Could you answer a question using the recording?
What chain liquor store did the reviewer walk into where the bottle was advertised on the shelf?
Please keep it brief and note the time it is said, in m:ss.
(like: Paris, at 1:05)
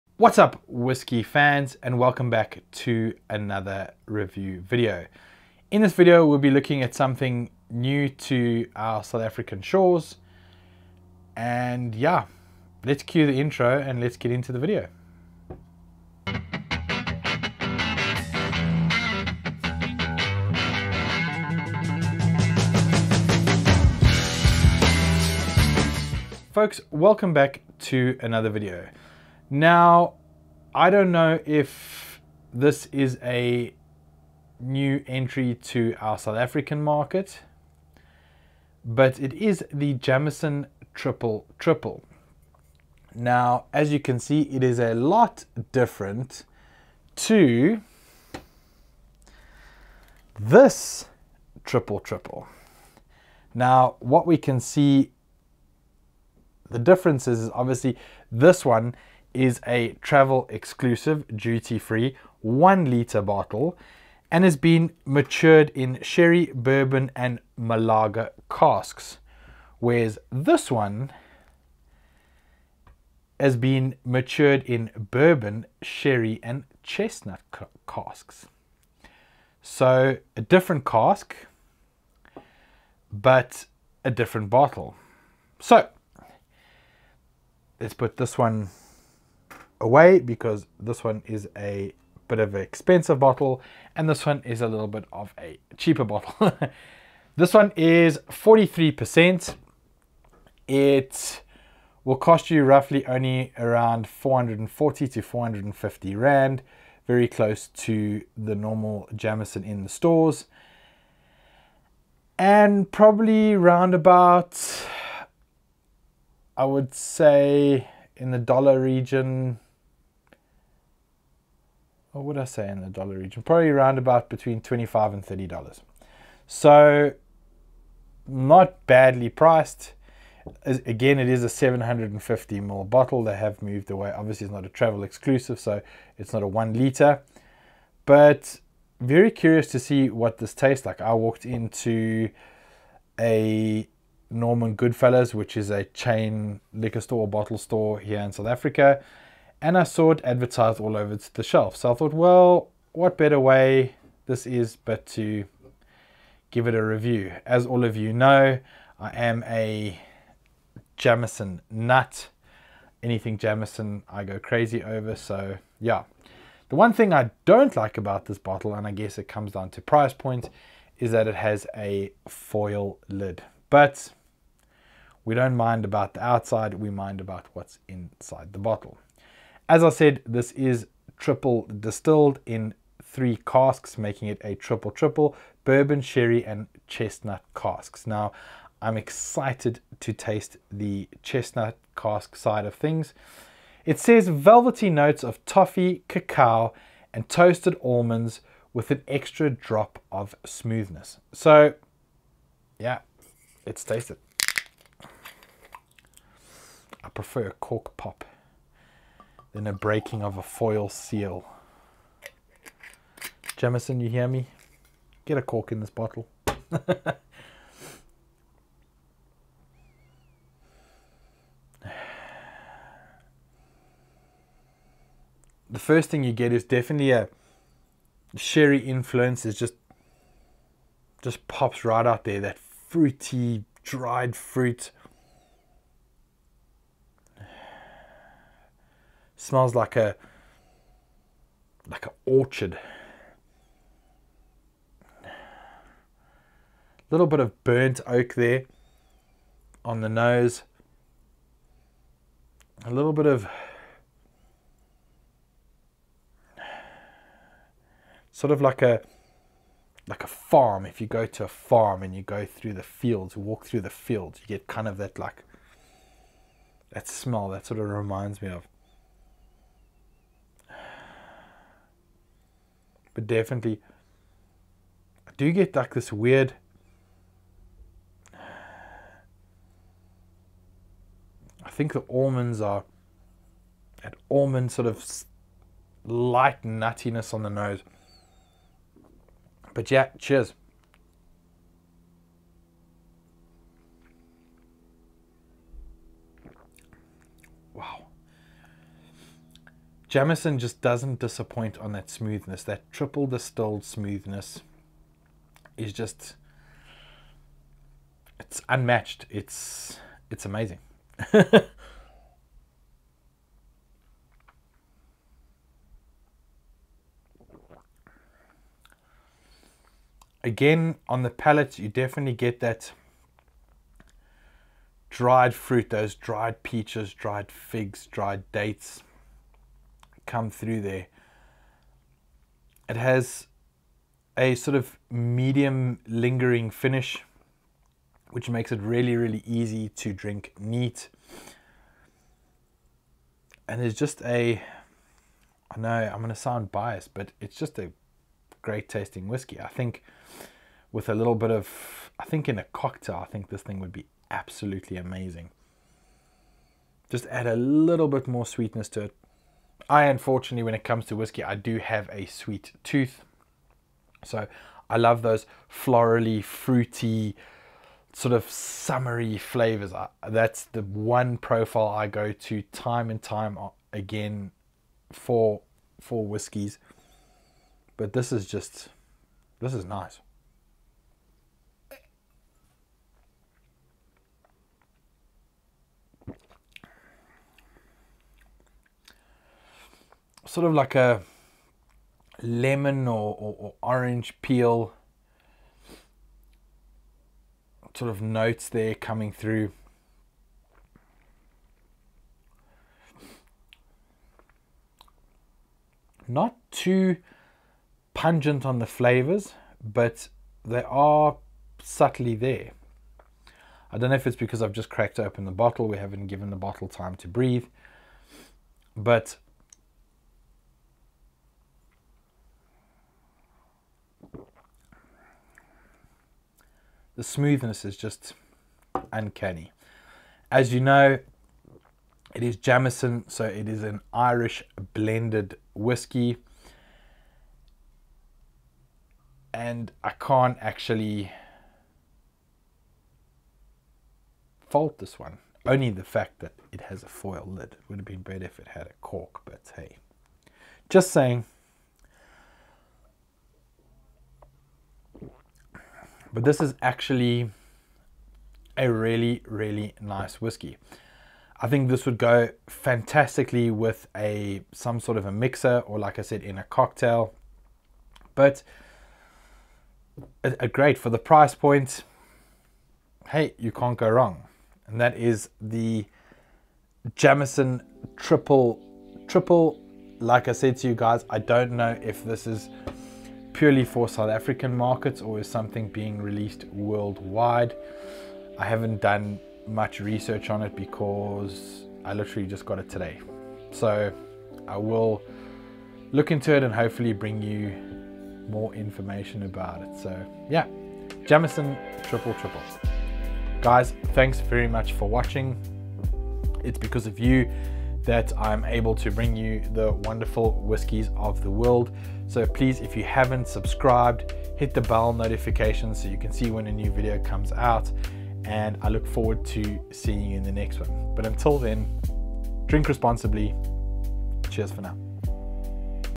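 Norman Goodfellows, at 2:24.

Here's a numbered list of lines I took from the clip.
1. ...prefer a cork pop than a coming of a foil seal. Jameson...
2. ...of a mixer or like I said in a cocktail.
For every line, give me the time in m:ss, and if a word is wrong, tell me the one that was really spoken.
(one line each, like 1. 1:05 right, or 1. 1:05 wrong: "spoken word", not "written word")
1. 3:27 wrong: "breaking", not "coming"
2. 7:45 right.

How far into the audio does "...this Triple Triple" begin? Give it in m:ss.
0:50.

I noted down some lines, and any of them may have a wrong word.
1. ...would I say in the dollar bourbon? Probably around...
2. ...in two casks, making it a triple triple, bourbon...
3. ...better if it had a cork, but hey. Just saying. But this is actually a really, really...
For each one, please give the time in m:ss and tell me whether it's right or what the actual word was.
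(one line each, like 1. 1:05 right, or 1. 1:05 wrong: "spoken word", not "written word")
1. 2:02 wrong: "region", not "bourbon"
2. 3:02 wrong: "three", not "two"
3. 7:28 right.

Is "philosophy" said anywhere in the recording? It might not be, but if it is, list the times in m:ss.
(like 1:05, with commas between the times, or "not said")
not said.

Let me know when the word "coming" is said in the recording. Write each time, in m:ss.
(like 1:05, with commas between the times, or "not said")
6:38.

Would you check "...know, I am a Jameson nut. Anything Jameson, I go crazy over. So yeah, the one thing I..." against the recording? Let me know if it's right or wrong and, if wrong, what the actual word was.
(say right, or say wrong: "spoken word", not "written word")
right.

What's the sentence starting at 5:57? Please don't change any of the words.
Just add a little bit more sweetness to it, I unfortunately, when it comes to whiskey, I do have a sweet tooth.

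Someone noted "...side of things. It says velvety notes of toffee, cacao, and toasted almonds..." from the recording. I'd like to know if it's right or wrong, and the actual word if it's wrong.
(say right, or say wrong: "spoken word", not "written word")
right.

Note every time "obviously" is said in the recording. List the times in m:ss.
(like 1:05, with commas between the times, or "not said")
0:57, 2:14.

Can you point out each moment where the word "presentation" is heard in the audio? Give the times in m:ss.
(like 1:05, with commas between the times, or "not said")
not said.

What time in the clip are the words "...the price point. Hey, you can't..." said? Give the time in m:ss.
7:51.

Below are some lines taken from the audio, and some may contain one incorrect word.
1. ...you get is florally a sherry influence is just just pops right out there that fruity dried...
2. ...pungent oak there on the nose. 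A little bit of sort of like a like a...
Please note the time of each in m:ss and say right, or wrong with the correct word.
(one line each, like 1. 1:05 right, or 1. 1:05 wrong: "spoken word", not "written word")
1. 3:46 wrong: "definitely", not "florally"
2. 4:07 wrong: "burnt", not "pungent".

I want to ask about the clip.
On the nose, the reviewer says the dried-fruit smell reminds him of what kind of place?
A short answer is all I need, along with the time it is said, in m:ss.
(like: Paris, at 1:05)
An orchard, at 4:02.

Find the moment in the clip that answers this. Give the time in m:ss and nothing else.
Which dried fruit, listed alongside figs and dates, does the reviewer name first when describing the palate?
5:26.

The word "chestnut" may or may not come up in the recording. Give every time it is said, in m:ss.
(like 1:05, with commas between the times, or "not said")
1:16, 3:06, 3:11.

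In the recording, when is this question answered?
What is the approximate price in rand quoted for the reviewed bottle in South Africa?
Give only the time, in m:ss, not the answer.
1:44.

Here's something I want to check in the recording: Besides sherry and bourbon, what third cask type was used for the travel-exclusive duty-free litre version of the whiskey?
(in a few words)
Malaga.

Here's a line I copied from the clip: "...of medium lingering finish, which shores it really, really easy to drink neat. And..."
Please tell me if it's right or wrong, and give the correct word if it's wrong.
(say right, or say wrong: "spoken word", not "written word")
wrong: "makes", not "shores".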